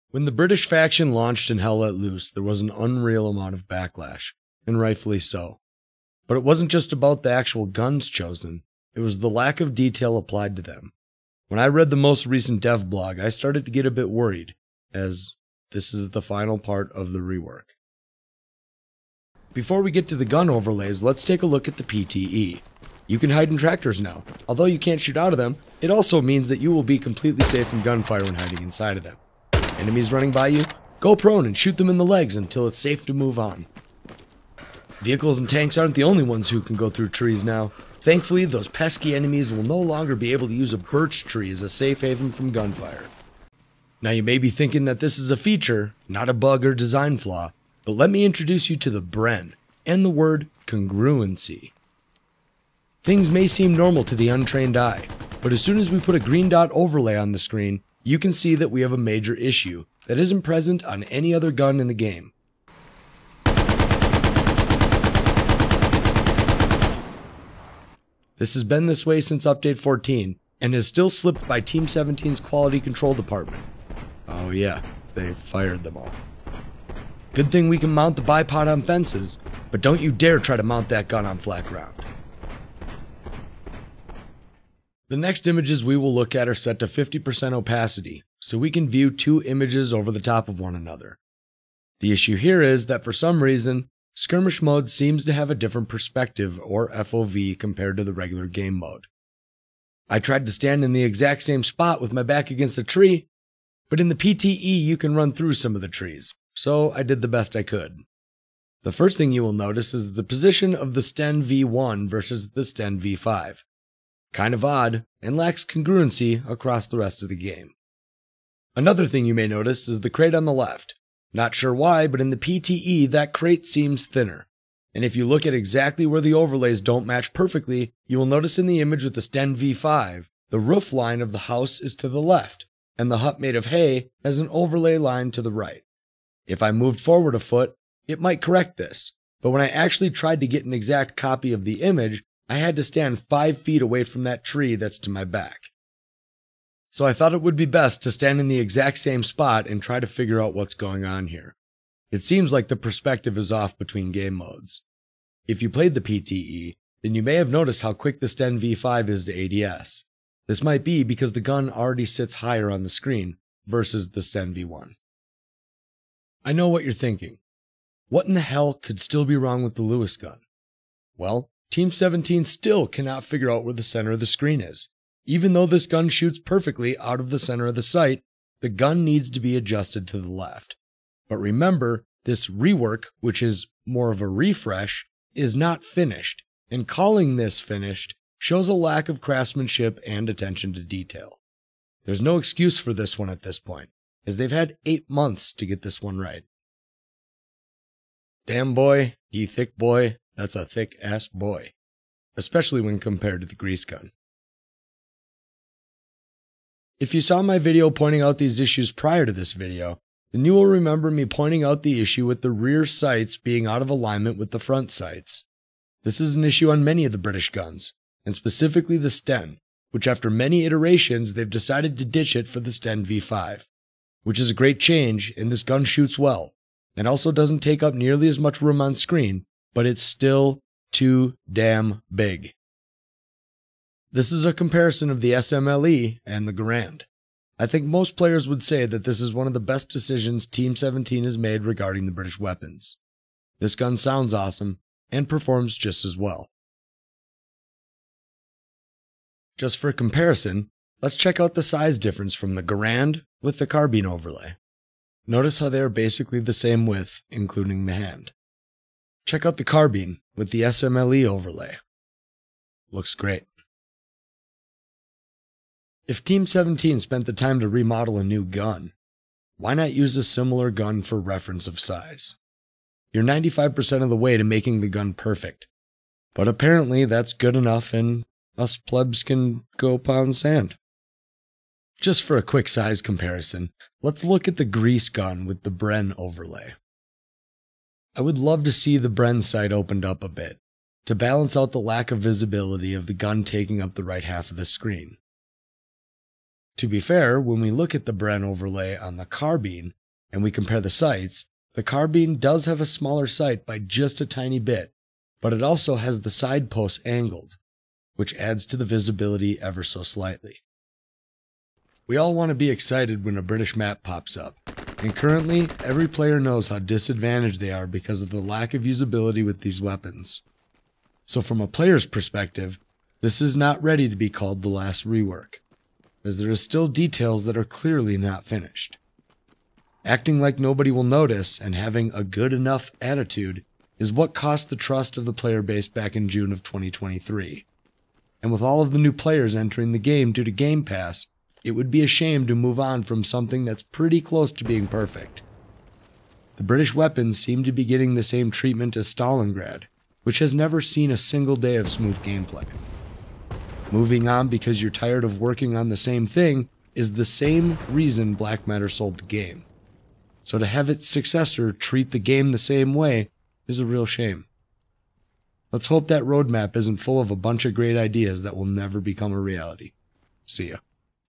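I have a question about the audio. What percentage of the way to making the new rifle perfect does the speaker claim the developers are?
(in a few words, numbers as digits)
95%.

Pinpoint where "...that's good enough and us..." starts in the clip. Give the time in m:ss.
4:37.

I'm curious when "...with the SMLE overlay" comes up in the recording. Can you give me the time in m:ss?
4:20.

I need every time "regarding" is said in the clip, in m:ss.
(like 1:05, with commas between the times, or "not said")
4:01.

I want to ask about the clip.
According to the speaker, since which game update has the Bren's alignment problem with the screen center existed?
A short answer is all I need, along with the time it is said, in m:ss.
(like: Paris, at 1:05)
Update 14, at 1:09.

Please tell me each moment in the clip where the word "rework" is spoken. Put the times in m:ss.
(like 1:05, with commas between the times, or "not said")
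0:17, 3:02, 5:25.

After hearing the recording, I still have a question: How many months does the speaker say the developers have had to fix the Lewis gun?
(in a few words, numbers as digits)
8.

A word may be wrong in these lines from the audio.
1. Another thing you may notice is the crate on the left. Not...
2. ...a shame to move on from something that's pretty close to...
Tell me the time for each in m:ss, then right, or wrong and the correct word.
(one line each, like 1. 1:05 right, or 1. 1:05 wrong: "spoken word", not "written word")
1. 1:58 right
2. 5:42 right.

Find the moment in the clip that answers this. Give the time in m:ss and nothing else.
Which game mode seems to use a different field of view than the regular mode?
1:34.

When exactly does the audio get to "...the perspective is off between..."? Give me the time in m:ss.
2:32.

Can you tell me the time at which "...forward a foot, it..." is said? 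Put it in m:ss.
2:17.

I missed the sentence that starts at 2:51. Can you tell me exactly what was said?
Well, Team 17 still cannot figure out where the center of the screen is.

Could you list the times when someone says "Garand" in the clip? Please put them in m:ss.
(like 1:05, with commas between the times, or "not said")
3:56, 4:12.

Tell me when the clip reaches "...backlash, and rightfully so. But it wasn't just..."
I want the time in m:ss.
0:03.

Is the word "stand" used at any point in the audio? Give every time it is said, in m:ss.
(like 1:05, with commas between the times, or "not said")
1:40, 2:22, 2:28.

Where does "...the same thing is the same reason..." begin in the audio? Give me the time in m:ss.
5:55.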